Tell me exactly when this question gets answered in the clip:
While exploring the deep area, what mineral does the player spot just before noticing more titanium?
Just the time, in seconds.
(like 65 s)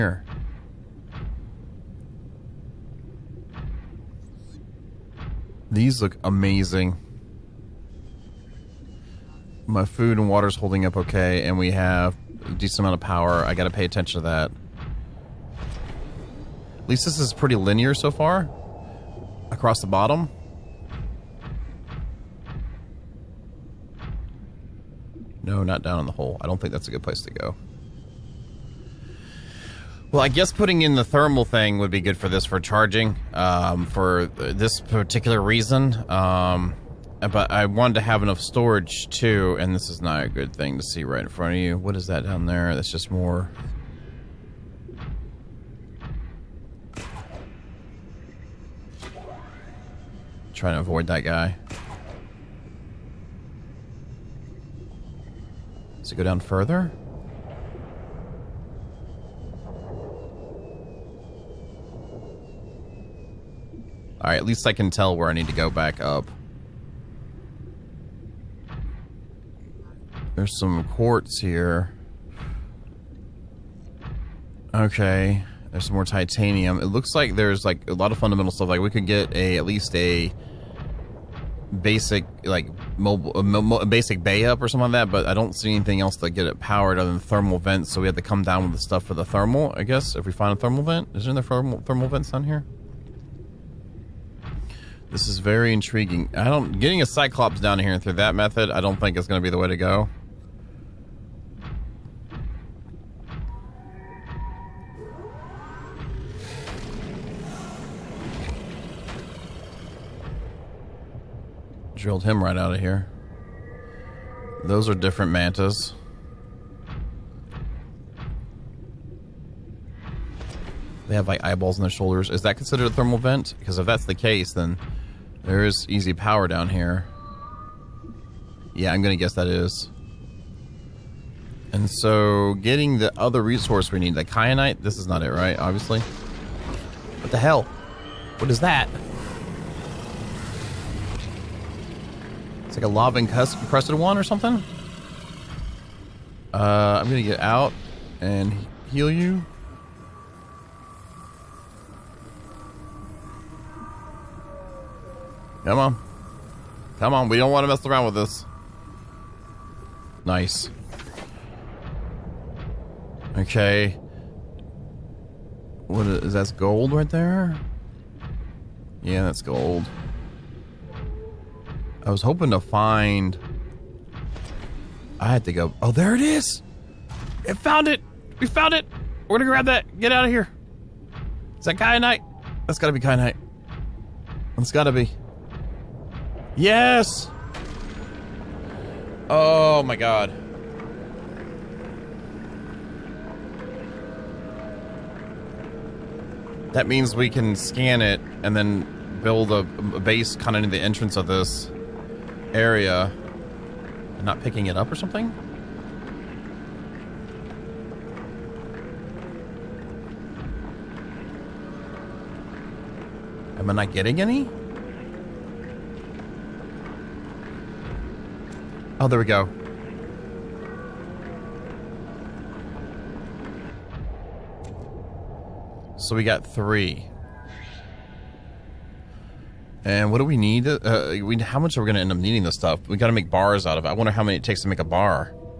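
70 s.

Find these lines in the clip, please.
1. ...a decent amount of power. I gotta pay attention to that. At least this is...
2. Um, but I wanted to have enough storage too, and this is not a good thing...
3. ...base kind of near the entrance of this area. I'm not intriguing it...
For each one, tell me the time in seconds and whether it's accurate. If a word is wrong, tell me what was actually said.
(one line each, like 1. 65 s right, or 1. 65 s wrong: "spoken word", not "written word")
1. 12 s right
2. 36 s right
3. 200 s wrong: "picking", not "intriguing".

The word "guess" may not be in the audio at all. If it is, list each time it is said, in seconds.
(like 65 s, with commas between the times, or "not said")
30 s, 89 s, 129 s.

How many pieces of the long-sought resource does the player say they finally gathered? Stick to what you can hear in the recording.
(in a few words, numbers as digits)
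3.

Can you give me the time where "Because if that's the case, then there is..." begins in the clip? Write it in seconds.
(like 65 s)
123 s.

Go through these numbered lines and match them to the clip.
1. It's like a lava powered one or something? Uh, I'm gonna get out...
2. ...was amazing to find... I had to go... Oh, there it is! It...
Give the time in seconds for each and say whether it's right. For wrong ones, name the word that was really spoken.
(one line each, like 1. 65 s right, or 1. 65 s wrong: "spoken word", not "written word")
1. 142 s wrong: "encrusted", not "powered"
2. 172 s wrong: "hoping", not "amazing".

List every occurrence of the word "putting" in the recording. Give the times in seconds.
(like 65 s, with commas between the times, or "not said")
30 s.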